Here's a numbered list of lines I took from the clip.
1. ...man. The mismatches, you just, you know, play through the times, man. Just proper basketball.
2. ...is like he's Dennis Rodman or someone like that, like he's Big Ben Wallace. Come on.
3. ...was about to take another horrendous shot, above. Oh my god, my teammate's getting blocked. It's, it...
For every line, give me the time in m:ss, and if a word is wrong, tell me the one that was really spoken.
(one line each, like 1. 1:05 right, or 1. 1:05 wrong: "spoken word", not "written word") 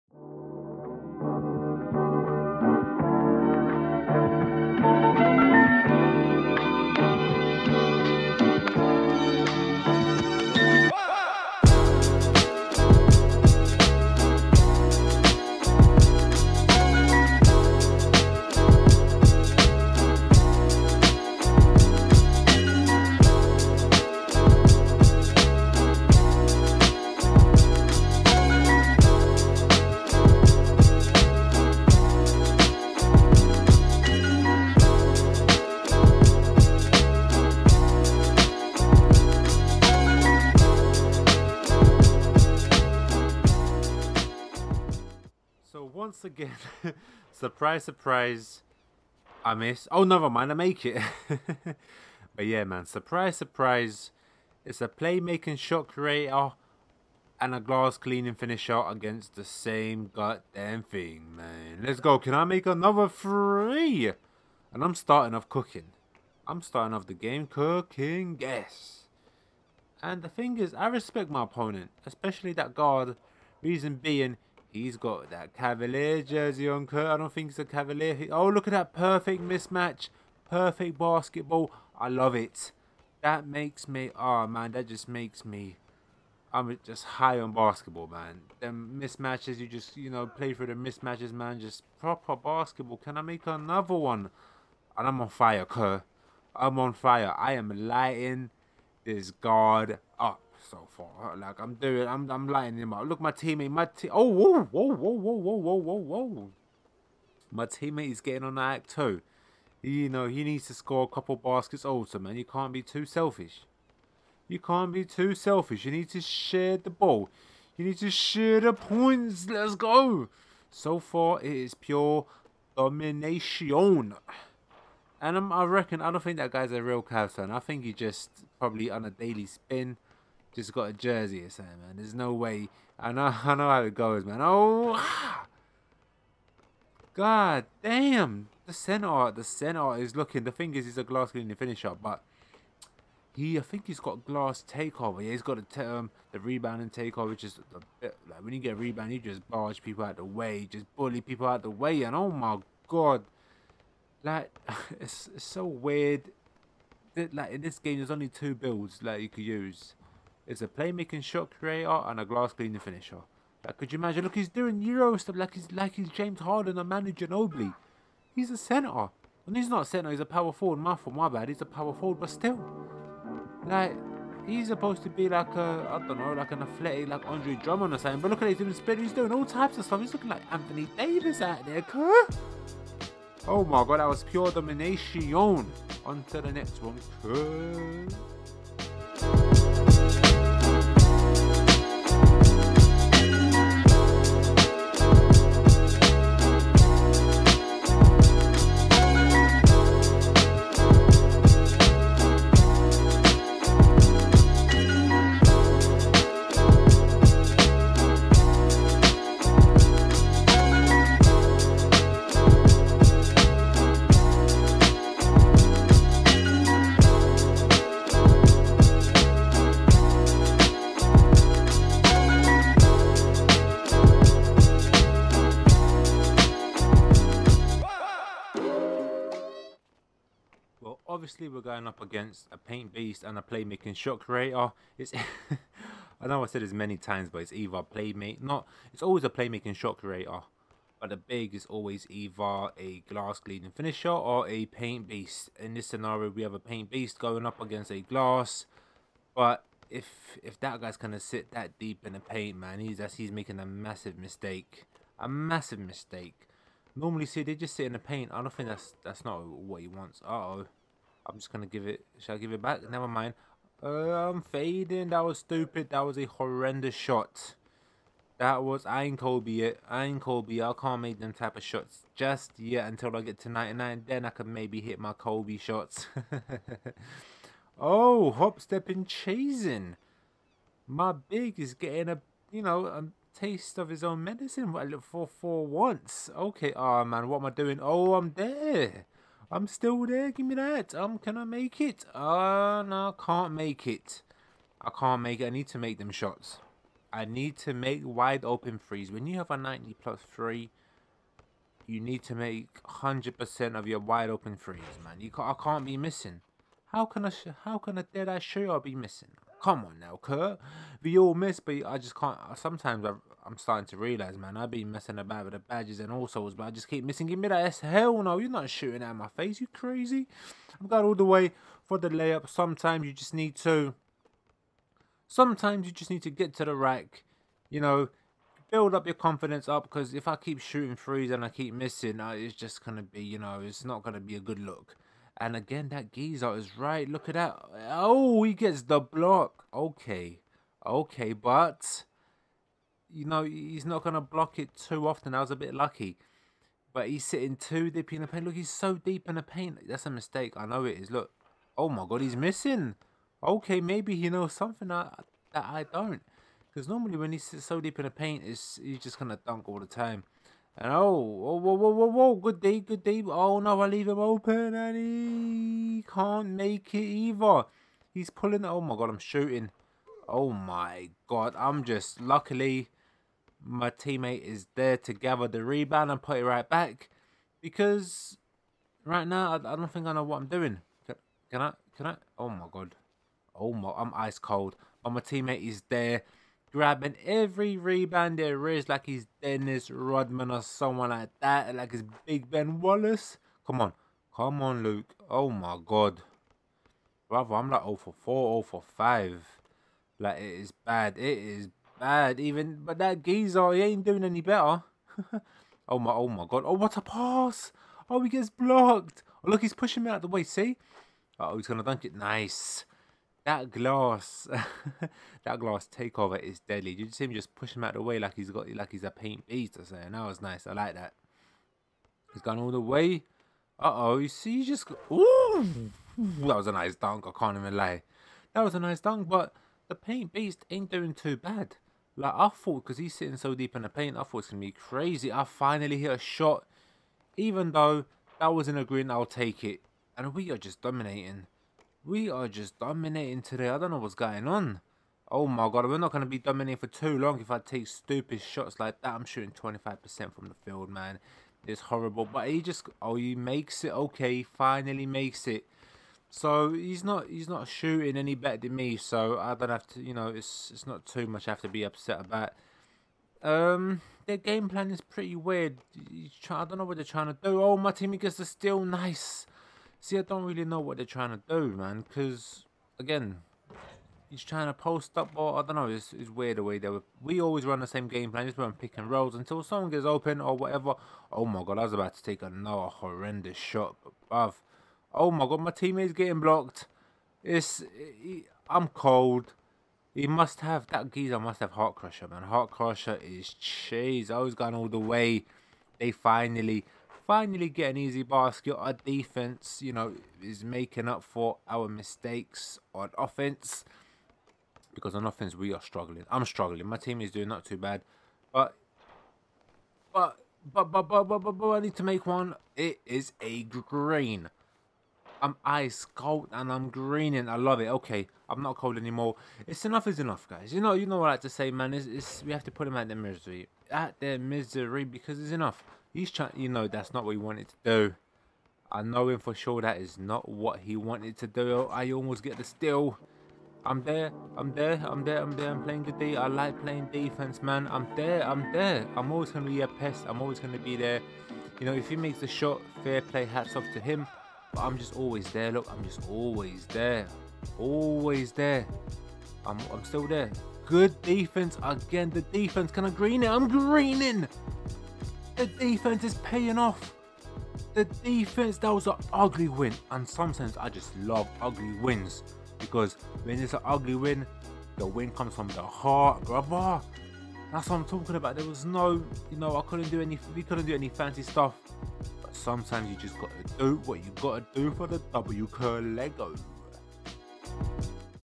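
1. 1:28 wrong: "mismatches", not "times"
2. 6:28 right
3. 8:01 right.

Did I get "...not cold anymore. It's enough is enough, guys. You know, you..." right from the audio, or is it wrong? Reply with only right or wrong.
right.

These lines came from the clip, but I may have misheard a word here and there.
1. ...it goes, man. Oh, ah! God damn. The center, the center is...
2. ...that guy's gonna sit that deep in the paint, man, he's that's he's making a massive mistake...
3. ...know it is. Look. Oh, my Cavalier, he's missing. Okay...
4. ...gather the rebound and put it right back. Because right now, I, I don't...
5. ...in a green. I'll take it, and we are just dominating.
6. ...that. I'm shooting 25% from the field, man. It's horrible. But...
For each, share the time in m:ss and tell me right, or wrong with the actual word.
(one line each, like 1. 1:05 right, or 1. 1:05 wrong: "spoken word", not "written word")
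1. 2:13 right
2. 4:10 right
3. 5:50 wrong: "God", not "Cavalier"
4. 6:15 right
5. 7:18 right
6. 7:29 right.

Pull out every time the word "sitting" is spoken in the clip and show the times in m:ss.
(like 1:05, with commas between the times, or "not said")
5:47, 7:13.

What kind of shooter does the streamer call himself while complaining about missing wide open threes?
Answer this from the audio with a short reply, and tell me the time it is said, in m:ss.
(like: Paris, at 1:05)
Dead eye, at 5:08.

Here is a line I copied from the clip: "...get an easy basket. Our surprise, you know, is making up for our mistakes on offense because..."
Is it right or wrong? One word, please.
wrong.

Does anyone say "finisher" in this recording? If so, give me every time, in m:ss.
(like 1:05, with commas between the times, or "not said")
0:58, 2:21, 2:42, 4:03.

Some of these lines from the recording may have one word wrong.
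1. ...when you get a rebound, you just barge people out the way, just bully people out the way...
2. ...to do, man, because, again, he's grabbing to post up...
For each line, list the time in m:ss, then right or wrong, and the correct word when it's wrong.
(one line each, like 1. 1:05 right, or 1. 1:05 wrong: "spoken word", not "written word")
1. 2:28 right
2. 7:51 wrong: "trying", not "grabbing".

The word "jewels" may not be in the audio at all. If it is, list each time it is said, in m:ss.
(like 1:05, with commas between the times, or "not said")
not said.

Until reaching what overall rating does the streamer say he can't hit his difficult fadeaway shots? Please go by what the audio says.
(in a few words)
99.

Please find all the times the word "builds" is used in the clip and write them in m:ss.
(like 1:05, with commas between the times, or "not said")
2:38, 5:28.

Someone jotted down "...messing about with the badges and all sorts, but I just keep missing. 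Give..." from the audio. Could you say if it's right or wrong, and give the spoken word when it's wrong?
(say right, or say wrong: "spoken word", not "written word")
right.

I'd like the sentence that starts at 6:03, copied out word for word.
Oh no, I leave him open and he can't make it either.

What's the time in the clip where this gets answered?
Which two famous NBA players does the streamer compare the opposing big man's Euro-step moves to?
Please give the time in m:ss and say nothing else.
2:46.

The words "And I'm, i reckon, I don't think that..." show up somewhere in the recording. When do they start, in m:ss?
2:05.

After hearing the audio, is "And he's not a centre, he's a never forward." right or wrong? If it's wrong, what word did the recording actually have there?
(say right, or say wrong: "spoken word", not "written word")
wrong: "power", not "never".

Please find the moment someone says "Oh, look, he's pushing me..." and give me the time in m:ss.
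6:49.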